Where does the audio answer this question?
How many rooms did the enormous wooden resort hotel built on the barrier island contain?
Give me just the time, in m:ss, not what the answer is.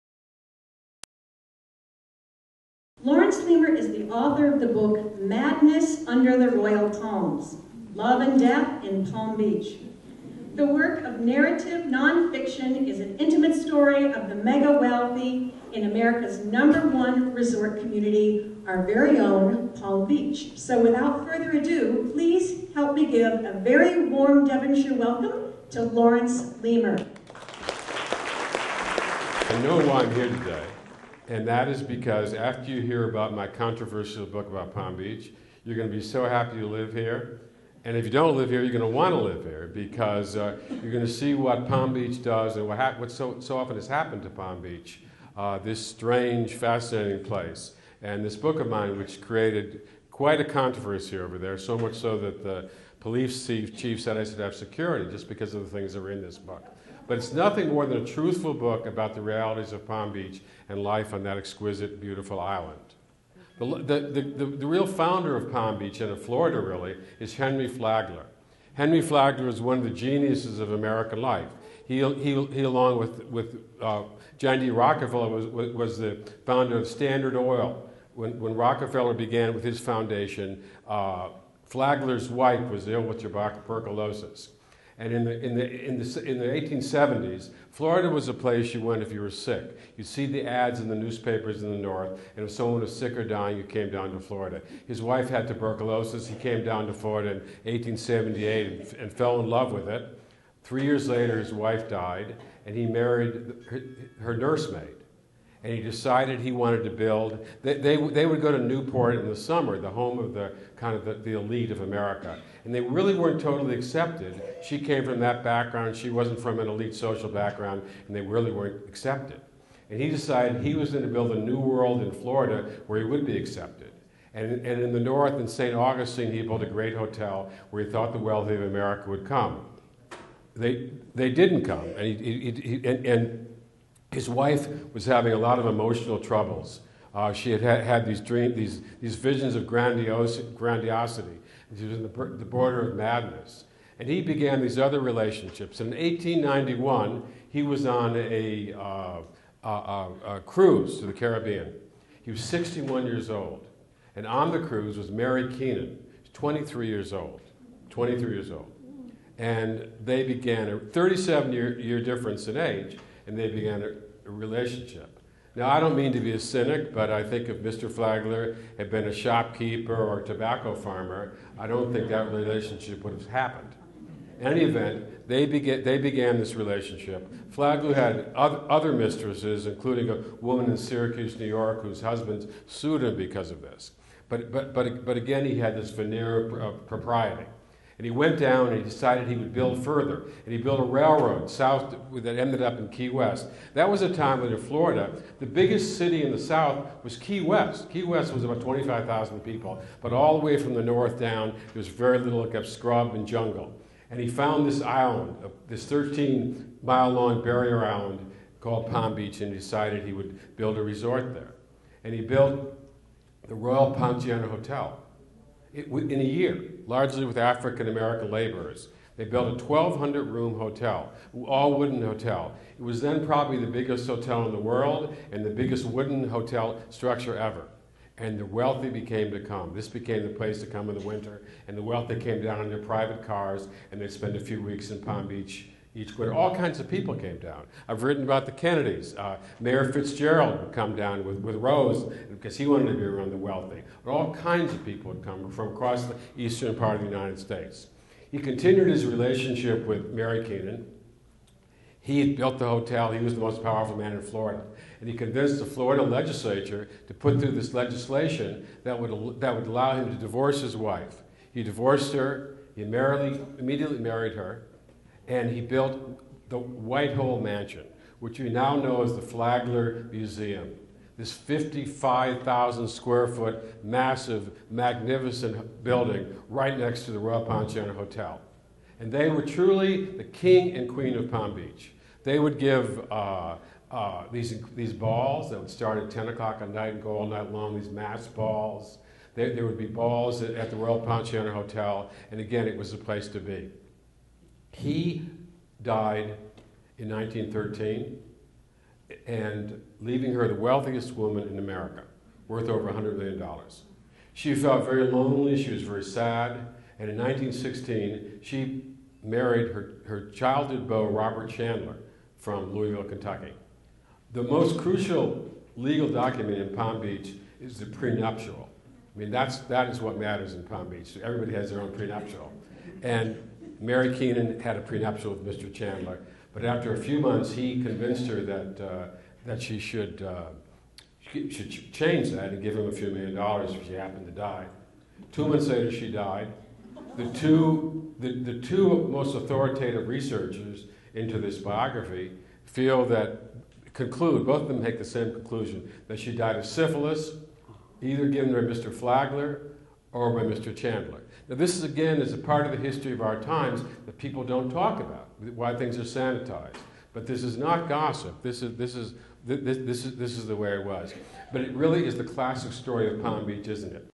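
3:39.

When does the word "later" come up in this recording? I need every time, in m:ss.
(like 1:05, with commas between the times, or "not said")
1:41, 5:35.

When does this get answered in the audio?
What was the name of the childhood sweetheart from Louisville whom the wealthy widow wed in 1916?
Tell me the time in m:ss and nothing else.
5:11.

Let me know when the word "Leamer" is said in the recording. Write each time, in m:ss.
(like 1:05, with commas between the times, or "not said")
0:03, 0:26.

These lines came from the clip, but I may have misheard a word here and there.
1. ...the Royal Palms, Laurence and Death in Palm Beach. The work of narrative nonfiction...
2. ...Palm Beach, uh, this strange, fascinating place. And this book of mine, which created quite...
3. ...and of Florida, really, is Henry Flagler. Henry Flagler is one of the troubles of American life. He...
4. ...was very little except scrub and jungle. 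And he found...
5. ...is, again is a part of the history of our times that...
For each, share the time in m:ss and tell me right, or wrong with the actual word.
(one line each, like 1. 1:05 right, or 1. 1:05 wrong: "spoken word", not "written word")
1. 0:06 wrong: "Love", not "Laurence"
2. 0:44 right
3. 1:05 wrong: "geniuses", not "troubles"
4. 3:21 right
5. 5:51 right.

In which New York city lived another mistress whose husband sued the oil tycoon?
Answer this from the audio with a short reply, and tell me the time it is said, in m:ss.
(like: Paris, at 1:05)
Syracuse, at 3:00.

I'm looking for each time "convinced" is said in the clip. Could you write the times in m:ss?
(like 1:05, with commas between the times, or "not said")
4:15, 5:27.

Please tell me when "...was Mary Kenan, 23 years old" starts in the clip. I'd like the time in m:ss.
2:34.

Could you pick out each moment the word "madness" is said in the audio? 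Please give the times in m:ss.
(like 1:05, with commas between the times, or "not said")
0:05, 2:22.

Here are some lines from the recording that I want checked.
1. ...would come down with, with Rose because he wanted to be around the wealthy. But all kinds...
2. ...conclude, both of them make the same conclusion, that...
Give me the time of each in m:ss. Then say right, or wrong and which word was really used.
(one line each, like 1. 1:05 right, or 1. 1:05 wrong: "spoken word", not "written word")
1. 4:00 right
2. 5:43 right.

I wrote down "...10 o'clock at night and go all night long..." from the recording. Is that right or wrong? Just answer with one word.
right.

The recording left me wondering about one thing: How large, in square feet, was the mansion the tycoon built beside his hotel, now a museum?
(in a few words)
55,000.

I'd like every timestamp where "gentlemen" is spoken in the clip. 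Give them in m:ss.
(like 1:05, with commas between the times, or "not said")
not said.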